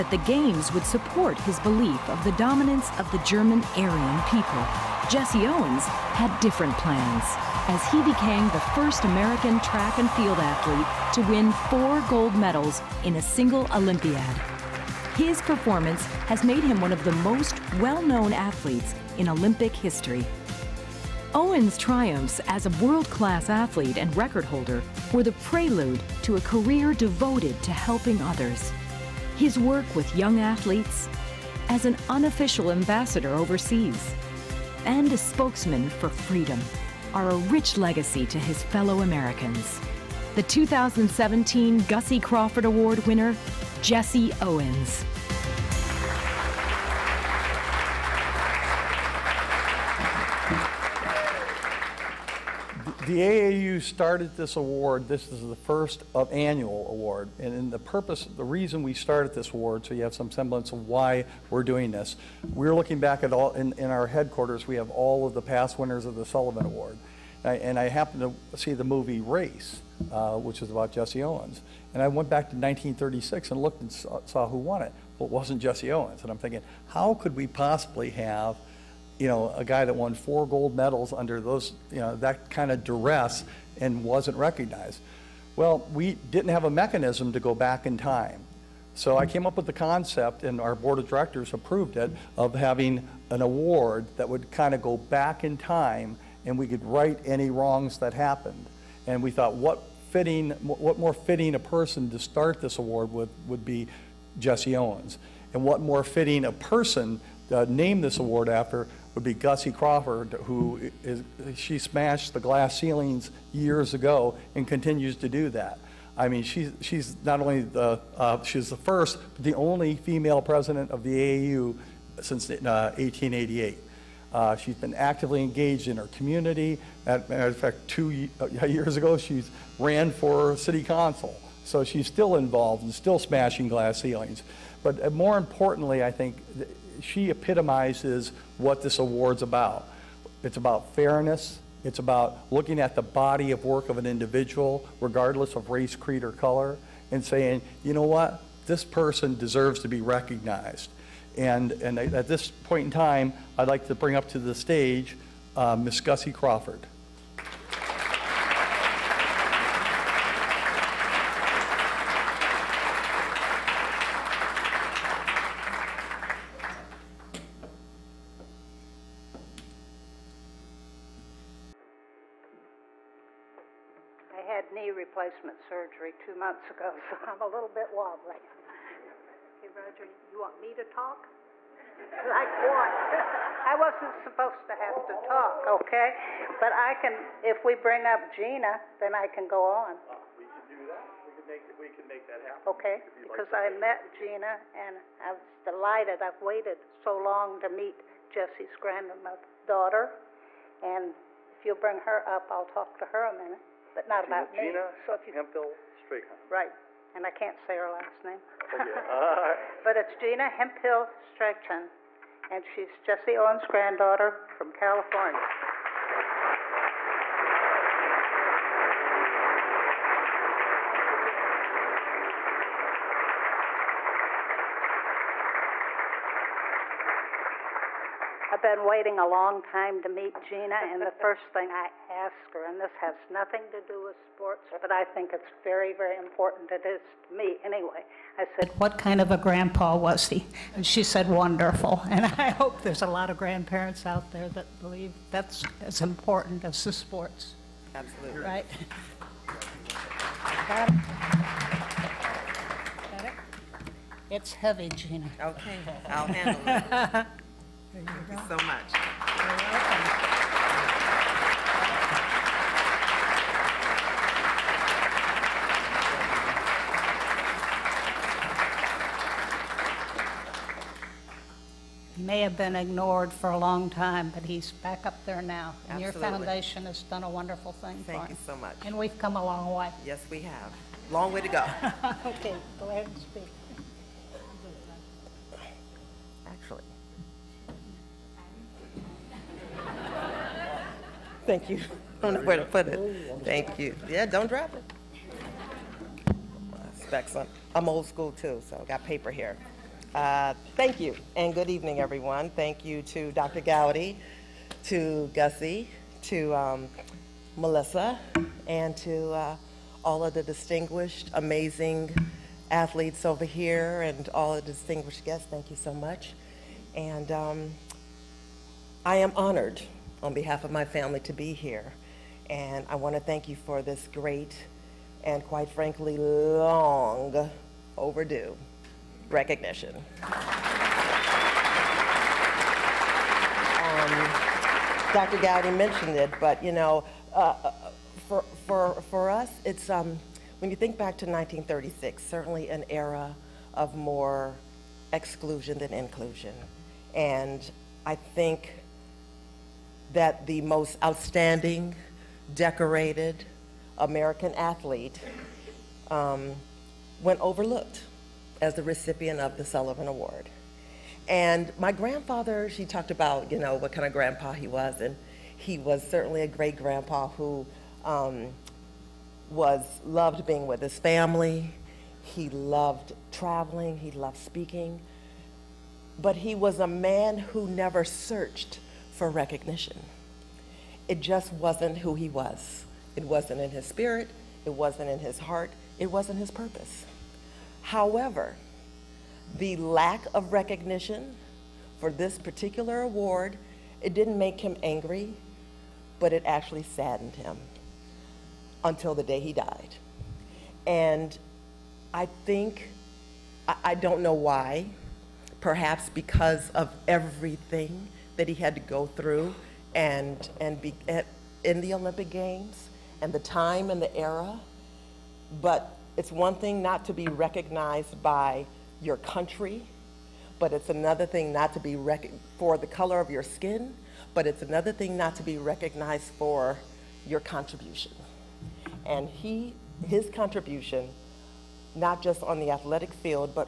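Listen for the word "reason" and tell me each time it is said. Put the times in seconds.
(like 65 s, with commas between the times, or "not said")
58 s.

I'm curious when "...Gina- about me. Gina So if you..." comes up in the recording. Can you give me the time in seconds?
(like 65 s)
204 s.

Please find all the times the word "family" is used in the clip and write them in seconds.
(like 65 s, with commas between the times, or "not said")
320 s, 370 s.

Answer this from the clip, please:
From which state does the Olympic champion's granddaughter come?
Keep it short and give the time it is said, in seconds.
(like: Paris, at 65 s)
California, at 214 s.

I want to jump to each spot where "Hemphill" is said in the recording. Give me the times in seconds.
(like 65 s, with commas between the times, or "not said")
205 s, 210 s.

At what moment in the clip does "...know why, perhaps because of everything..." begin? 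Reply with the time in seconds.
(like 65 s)
404 s.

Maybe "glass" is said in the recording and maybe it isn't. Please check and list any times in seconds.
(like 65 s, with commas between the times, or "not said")
112 s, 133 s.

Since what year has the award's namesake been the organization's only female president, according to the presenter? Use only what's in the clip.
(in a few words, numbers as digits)
1888.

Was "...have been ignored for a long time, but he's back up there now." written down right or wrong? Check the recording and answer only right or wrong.
right.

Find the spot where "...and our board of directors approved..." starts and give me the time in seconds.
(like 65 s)
90 s.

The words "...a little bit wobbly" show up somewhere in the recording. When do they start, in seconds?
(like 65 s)
177 s.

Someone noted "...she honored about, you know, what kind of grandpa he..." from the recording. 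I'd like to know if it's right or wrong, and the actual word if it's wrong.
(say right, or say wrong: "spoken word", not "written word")
wrong: "talked", not "honored".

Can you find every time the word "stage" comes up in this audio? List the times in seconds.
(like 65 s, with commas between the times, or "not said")
154 s.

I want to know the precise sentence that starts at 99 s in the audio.
And we thought, what fitting, what more fitting a person to start this award with would be Jesse Owens.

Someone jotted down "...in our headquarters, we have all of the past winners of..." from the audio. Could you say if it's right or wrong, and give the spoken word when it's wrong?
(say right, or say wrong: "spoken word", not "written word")
right.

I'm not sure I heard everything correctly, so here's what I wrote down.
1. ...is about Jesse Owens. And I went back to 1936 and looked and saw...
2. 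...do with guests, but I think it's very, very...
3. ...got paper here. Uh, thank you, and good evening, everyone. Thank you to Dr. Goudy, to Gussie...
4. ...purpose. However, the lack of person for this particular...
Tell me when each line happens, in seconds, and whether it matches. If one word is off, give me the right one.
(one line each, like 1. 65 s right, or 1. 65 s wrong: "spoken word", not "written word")
1. 70 s right
2. 233 s wrong: "sports", not "guests"
3. 298 s right
4. 386 s wrong: "recognition", not "person".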